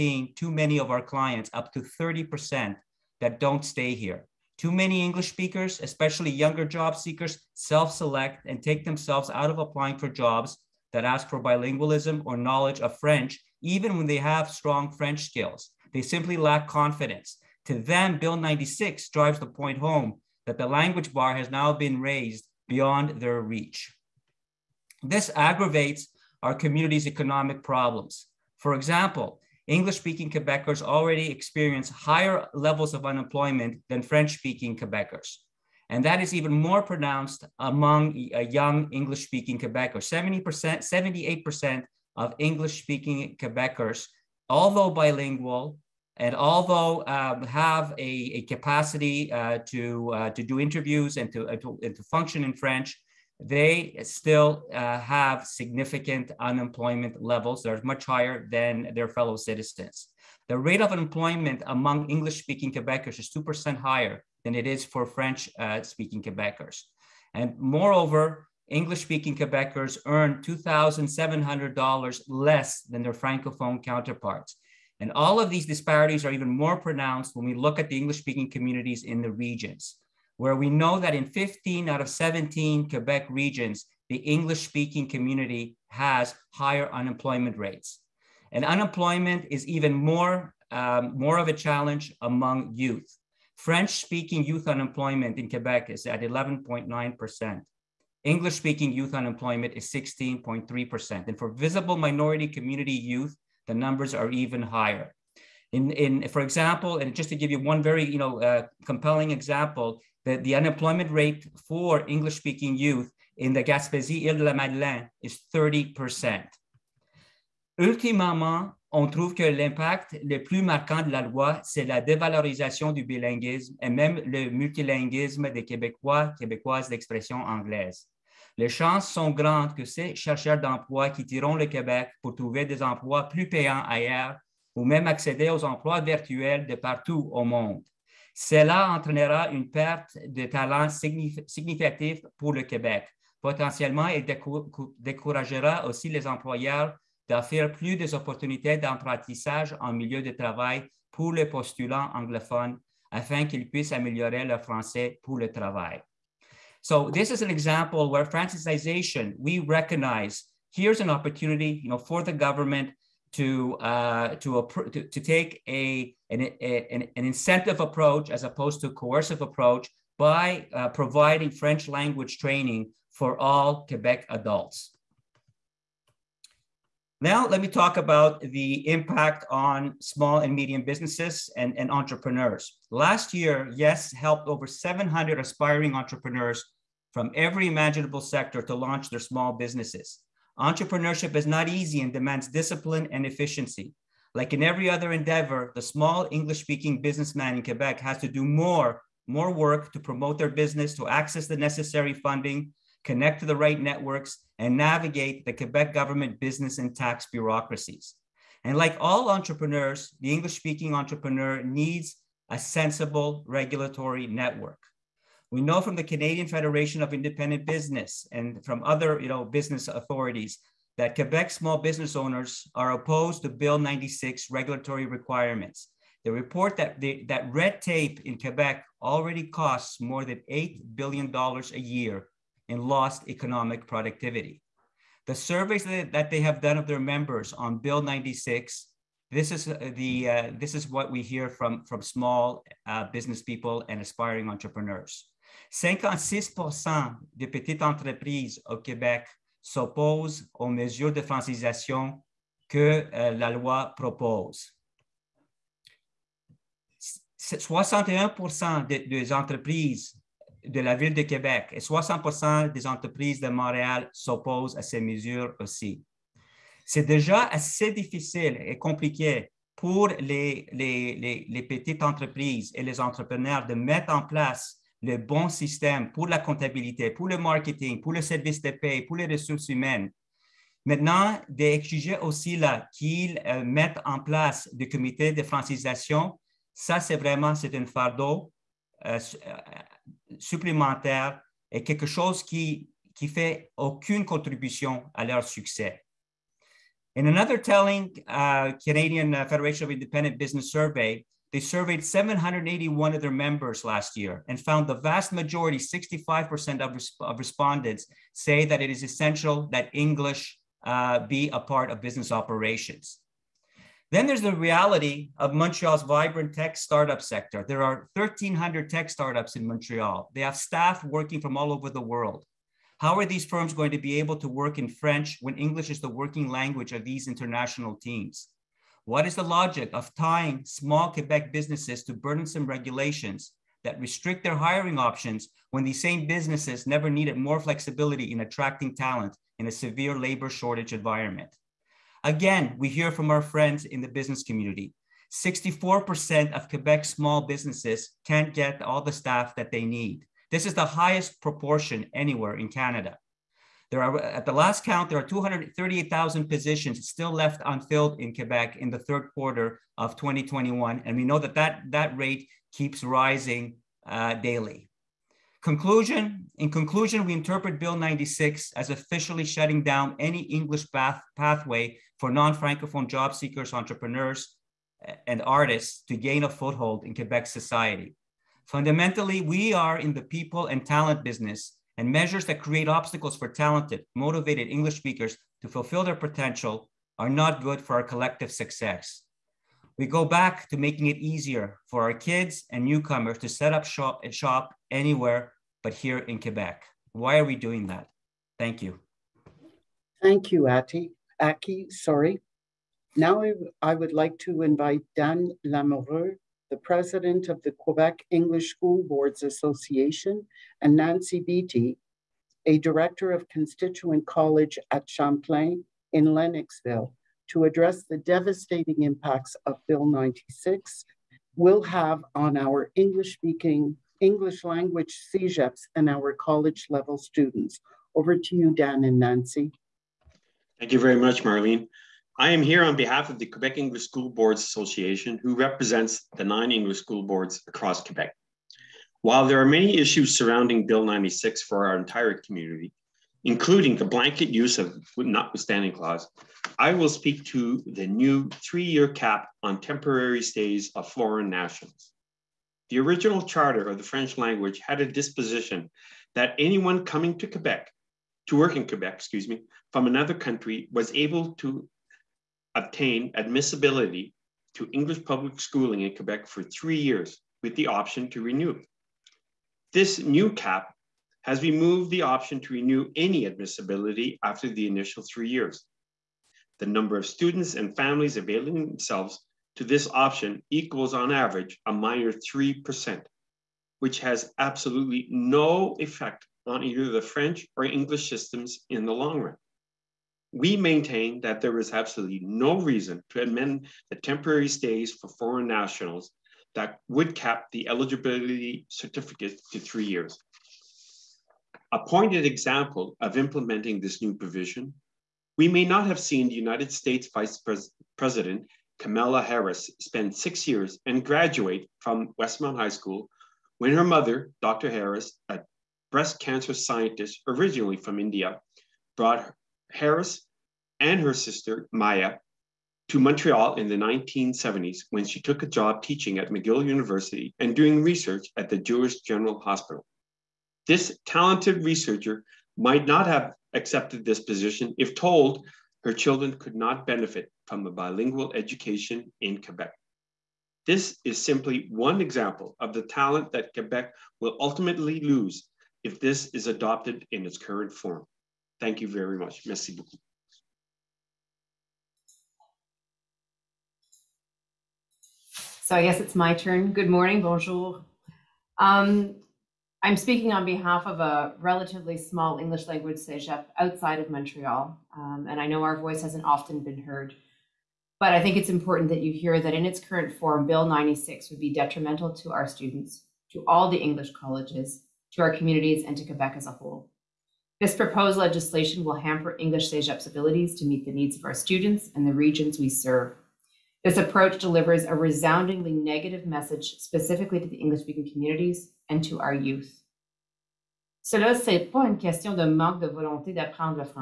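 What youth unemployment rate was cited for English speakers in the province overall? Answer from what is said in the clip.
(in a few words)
16.3%.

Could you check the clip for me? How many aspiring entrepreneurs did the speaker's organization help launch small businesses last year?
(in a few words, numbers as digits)
700.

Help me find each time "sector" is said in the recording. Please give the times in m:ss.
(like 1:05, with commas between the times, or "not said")
3:08, 5:17.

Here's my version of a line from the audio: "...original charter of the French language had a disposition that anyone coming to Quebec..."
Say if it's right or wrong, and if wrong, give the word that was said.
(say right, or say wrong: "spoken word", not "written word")
right.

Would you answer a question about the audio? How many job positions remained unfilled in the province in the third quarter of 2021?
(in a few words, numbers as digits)
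238,000.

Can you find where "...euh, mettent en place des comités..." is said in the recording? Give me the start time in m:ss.
4:43.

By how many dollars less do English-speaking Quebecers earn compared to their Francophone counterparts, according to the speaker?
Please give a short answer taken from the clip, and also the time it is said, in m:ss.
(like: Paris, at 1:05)
$2,700, at 1:10.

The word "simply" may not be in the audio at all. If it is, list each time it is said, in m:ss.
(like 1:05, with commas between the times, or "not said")
0:16, 9:01.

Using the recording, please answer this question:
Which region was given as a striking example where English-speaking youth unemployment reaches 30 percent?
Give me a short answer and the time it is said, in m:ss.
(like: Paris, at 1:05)
Gaspésie, Île de la Madeleine, at 1:53.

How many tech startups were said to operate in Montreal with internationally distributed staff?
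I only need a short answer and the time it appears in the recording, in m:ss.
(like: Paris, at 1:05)
1,300, at 5:18.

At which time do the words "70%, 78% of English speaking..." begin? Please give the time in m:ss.
0:40.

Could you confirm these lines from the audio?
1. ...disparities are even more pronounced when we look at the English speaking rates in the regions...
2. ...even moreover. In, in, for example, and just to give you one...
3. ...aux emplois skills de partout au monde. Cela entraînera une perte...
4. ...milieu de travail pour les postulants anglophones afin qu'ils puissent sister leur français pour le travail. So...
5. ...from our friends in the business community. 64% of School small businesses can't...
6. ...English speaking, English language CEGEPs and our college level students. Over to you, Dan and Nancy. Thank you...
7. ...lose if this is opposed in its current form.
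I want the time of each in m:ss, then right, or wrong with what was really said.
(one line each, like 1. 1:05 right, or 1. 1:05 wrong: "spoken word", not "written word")
1. 1:15 wrong: "communities", not "rates"
2. 1:44 wrong: "higher", not "moreover"
3. 2:15 wrong: "virtuels", not "skills"
4. 2:29 wrong: "améliorer", not "sister"
5. 5:43 wrong: "Quebec", not "School"
6. 7:02 right
7. 9:05 wrong: "adopted", not "opposed".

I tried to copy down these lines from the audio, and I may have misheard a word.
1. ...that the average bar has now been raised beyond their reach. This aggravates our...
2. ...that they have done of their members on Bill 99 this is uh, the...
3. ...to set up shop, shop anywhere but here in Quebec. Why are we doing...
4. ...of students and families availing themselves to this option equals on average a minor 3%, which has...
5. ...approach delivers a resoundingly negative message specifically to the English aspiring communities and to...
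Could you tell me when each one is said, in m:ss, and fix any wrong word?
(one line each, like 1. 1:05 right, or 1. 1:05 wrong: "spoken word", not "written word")
1. 0:20 wrong: "language", not "average"
2. 3:55 wrong: "96", not "99"
3. 6:33 right
4. 7:57 right
5. 9:44 wrong: "speaking", not "aspiring".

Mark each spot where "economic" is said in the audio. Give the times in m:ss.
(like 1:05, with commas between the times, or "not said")
0:27, 3:53.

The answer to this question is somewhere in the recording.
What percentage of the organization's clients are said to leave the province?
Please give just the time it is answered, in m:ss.
0:01.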